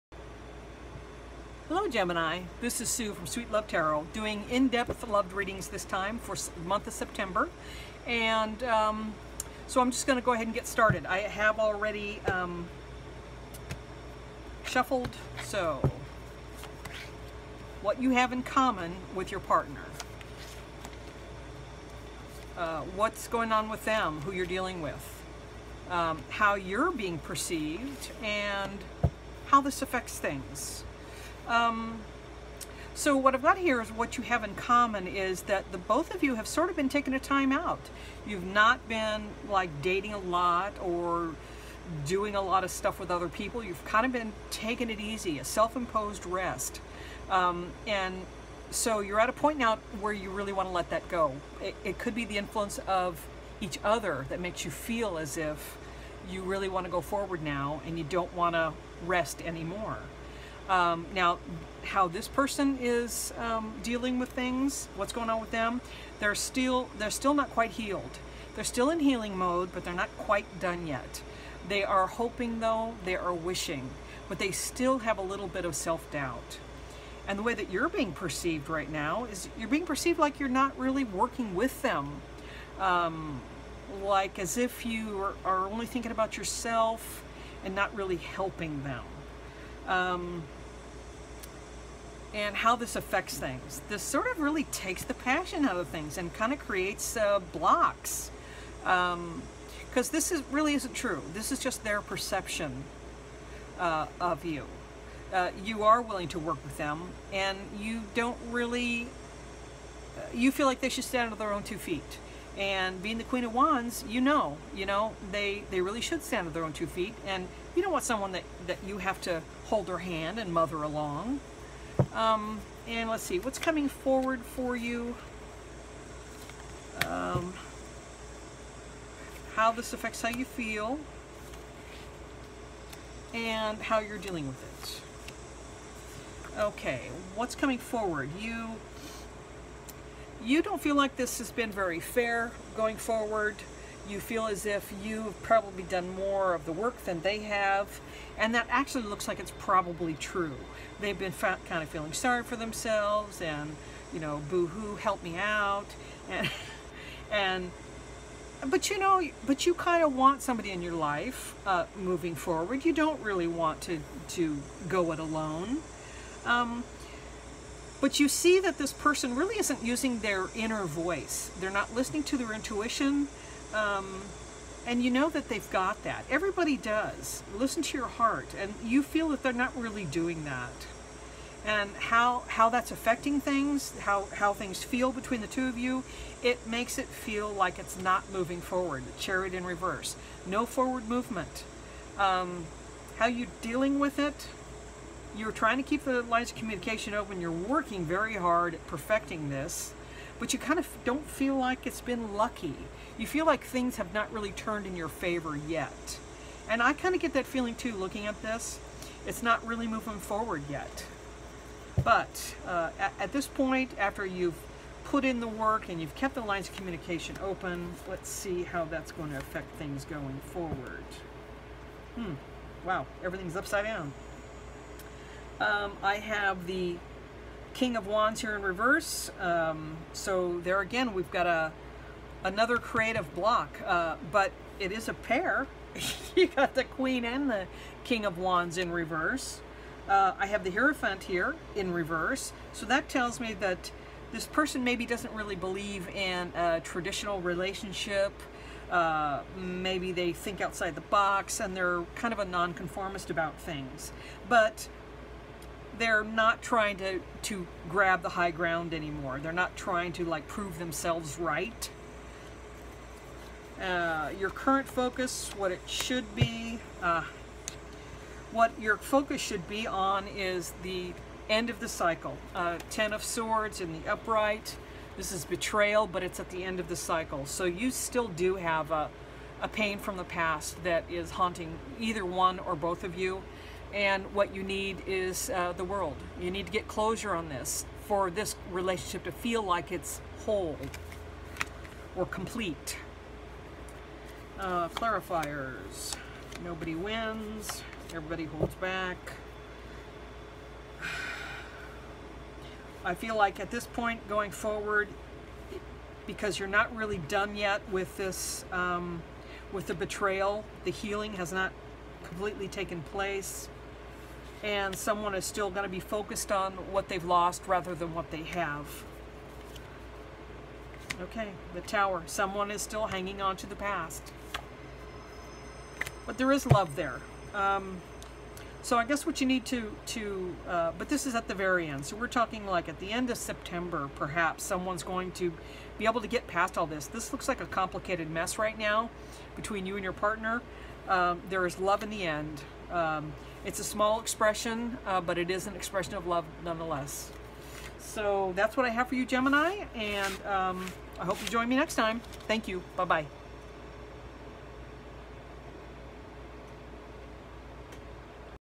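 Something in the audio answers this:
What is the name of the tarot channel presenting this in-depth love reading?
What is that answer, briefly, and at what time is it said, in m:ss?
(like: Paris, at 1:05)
Sweet Love Tarot, at 0:03.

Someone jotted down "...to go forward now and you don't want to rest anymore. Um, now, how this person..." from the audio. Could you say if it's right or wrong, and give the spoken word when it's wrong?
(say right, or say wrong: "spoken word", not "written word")
right.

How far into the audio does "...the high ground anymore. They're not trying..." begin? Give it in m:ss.
4:18.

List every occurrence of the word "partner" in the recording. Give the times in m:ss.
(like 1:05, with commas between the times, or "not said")
0:19, 5:40.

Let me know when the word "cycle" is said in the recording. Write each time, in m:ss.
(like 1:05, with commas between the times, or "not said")
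4:31, 4:36.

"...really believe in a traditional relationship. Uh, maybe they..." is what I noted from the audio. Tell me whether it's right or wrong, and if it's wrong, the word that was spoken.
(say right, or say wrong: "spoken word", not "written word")
right.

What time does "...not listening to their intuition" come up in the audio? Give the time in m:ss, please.
2:51.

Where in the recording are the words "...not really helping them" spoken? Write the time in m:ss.
1:27.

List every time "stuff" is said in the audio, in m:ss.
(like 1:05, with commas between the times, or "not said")
0:42.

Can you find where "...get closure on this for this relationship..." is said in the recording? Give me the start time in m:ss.
4:46.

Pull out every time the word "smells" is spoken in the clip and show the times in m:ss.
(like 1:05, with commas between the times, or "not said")
not said.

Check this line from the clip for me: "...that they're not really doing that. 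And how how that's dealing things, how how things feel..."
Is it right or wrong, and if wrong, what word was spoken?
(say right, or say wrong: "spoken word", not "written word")
wrong: "affecting", not "dealing".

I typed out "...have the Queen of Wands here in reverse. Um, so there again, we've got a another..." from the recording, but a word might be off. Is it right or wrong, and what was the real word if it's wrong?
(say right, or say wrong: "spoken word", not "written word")
wrong: "King", not "Queen".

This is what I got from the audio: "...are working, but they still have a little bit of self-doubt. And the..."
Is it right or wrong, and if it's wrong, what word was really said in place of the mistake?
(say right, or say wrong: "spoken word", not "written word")
wrong: "wishing", not "working".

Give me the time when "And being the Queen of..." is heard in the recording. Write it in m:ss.
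1:52.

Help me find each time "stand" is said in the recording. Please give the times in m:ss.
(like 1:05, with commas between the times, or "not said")
1:51, 1:56.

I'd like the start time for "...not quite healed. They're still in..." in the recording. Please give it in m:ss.
1:07.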